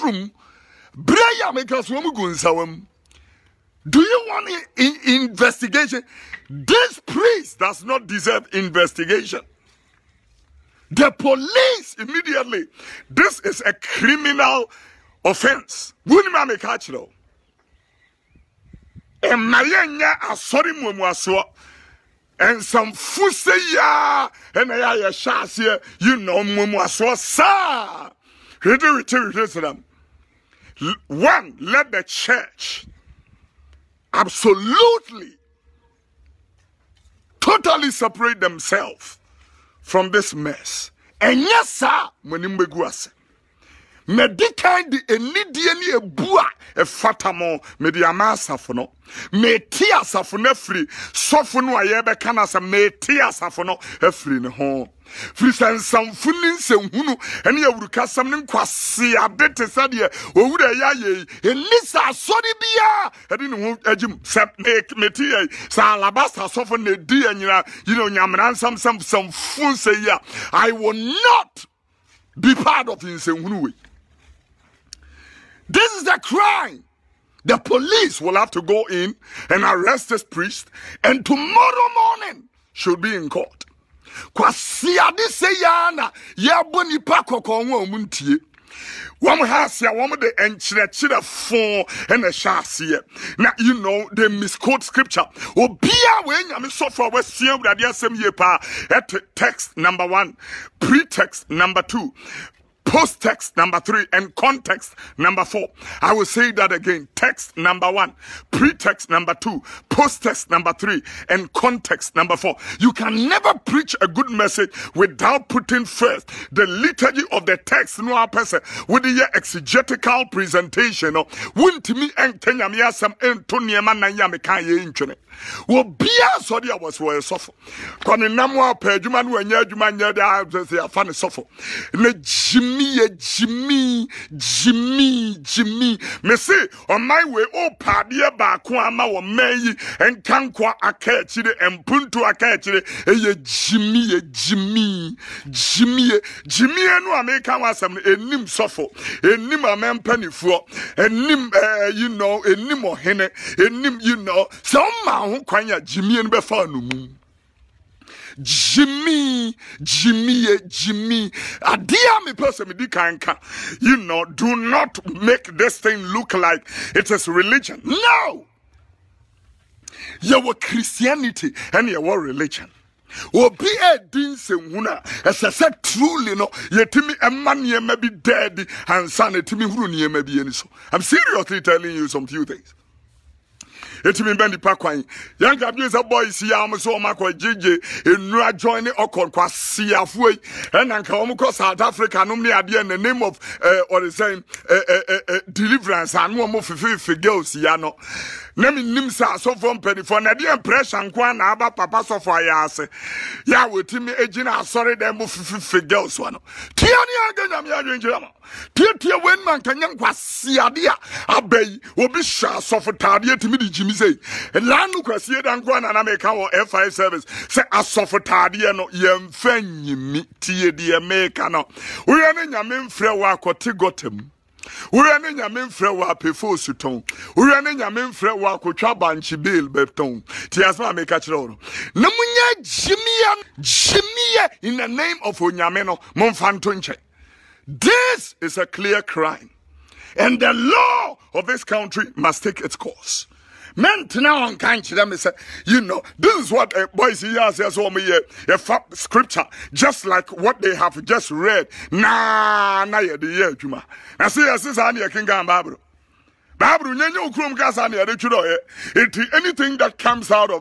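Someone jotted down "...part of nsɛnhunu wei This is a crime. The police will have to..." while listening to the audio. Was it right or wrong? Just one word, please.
right.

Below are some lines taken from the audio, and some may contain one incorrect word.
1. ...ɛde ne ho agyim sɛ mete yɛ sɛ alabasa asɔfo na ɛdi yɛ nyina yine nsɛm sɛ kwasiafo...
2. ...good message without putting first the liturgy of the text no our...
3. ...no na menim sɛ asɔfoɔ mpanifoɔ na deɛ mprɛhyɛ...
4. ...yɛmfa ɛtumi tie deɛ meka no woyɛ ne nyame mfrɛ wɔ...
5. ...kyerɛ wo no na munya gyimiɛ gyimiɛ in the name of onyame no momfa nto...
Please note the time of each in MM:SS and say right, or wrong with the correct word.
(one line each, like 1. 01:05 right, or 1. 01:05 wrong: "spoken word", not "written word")
1. 01:03 wrong: "nsamfo", not "kwasiafo"
2. 01:54 right
3. 03:17 right
4. 03:38 wrong: "nyimi", not "ɛtumi"
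5. 03:51 right.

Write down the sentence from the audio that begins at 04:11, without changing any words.
Nah, na ye the year, Juma.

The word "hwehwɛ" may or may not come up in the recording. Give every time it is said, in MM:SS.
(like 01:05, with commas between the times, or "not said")
00:29.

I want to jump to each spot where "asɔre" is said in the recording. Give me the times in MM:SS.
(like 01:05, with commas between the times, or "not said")
00:20, 01:02, 03:24.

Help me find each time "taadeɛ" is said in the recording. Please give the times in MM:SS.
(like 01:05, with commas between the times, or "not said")
03:32, 03:38.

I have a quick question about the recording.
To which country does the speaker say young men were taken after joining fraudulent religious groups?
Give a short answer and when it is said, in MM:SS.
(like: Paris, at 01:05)
South Africa, at 03:11.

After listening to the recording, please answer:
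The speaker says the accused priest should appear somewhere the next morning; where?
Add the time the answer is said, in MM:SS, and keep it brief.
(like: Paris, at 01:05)
In court, at 01:23.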